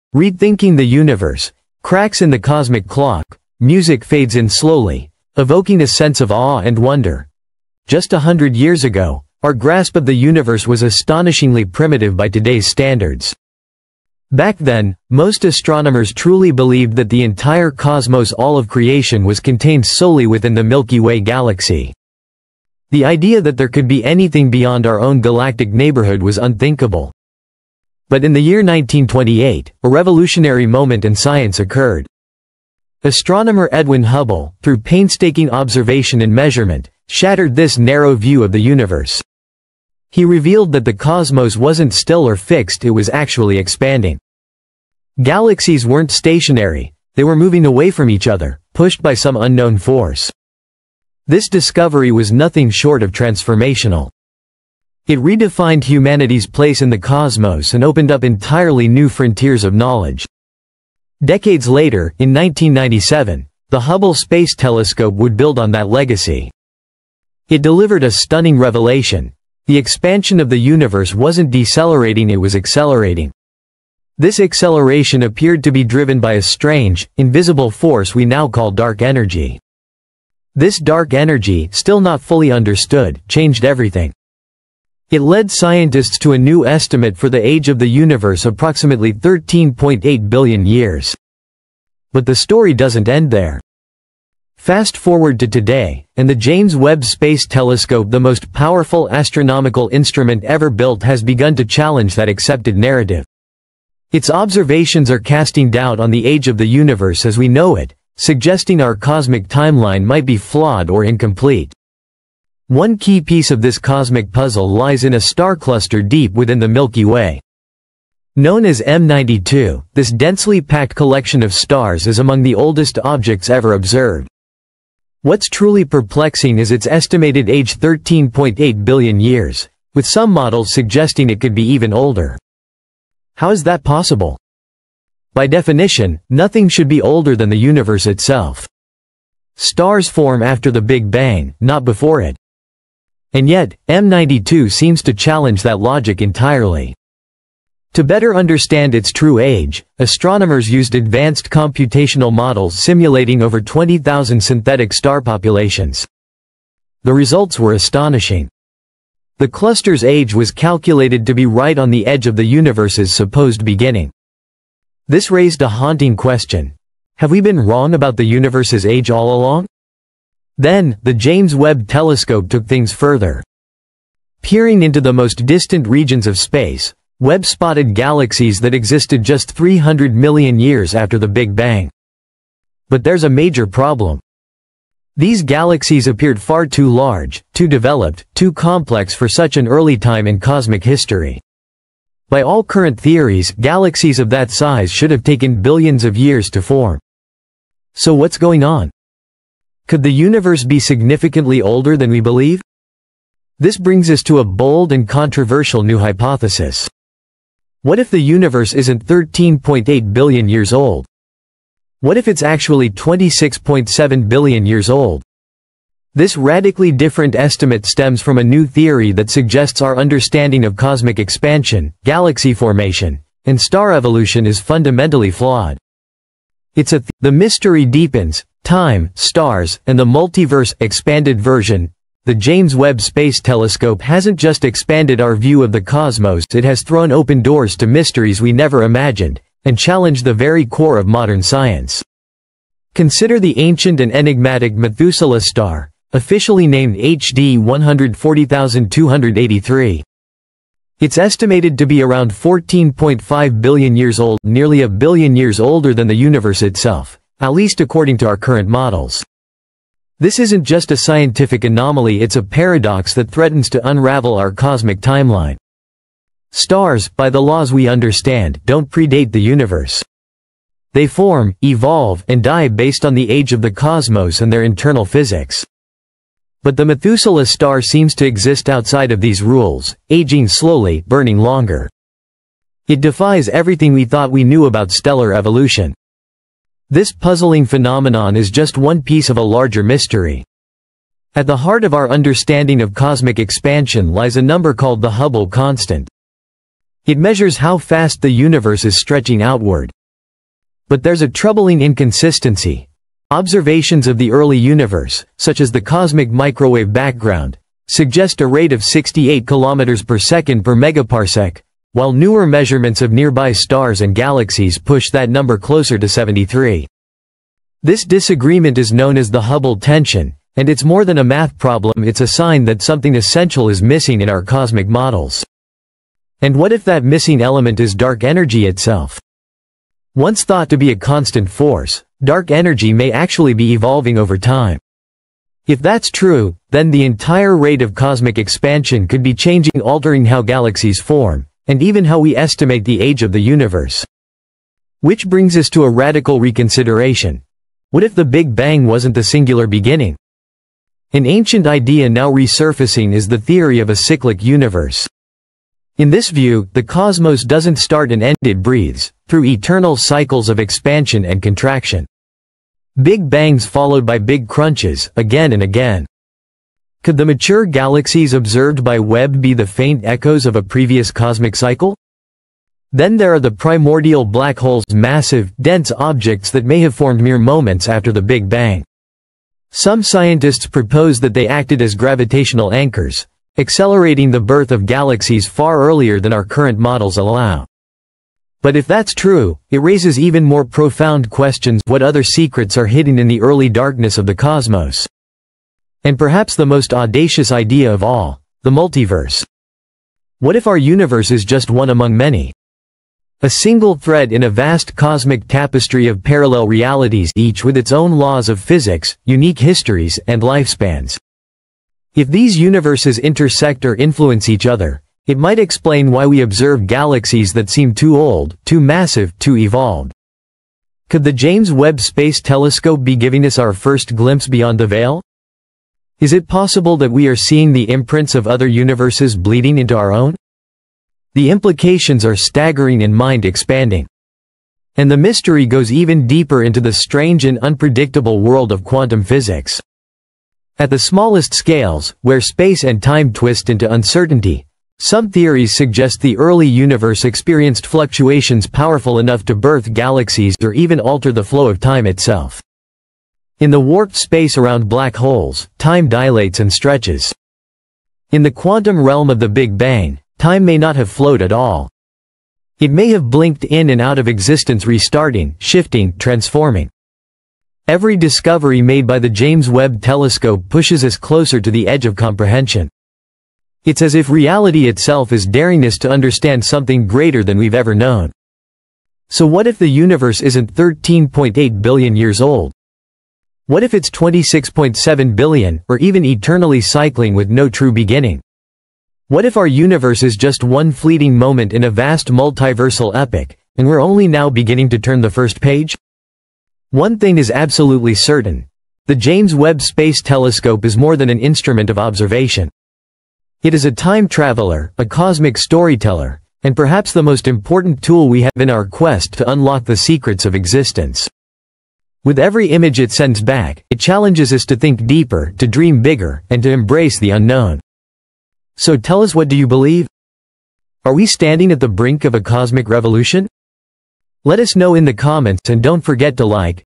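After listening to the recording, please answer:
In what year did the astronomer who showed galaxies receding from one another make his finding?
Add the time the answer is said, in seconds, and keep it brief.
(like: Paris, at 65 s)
1928, at 28 s.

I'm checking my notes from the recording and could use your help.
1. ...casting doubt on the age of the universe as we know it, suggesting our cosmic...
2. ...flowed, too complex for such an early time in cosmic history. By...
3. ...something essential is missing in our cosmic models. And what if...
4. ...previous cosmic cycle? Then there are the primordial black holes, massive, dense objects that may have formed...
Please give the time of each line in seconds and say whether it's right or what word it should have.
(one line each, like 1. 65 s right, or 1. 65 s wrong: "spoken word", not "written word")
1. 105 s right
2. 187 s wrong: "developed", not "flowed"
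3. 322 s right
4. 370 s right.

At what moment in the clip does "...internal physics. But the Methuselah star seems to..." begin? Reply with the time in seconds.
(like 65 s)
274 s.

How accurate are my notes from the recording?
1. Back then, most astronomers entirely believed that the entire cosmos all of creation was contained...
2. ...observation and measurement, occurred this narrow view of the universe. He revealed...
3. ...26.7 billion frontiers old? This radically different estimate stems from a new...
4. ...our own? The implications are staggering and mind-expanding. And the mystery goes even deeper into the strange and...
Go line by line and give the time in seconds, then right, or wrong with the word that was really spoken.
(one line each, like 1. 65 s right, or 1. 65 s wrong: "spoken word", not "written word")
1. 14 s wrong: "truly", not "entirely"
2. 35 s wrong: "shattered", not "occurred"
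3. 212 s wrong: "years", not "frontiers"
4. 429 s right.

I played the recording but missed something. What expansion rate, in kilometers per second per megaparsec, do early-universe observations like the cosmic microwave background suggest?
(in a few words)
68.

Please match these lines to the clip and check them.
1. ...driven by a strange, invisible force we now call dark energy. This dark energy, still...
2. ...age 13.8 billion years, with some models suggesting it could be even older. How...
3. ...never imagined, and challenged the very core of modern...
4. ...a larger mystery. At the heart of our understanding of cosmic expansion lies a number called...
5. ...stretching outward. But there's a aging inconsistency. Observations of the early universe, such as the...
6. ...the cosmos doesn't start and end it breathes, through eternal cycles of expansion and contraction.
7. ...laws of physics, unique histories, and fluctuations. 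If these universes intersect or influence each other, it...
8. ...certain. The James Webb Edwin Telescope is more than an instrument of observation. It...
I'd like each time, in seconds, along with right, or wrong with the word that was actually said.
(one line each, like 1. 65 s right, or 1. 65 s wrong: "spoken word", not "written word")
1. 75 s right
2. 127 s right
3. 238 s right
4. 289 s right
5. 298 s wrong: "troubling", not "aging"
6. 356 s right
7. 408 s wrong: "lifespans", not "fluctuations"
8. 498 s wrong: "Space", not "Edwin".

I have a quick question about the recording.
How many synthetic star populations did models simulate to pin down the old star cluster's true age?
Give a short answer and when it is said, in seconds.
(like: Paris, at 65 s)
20,000, at 153 s.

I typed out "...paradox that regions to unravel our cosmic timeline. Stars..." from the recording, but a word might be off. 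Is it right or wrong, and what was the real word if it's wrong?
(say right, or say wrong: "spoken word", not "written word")
wrong: "threatens", not "regions".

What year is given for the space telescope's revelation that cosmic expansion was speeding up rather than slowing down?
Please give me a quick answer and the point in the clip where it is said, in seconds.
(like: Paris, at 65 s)
1997, at 62 s.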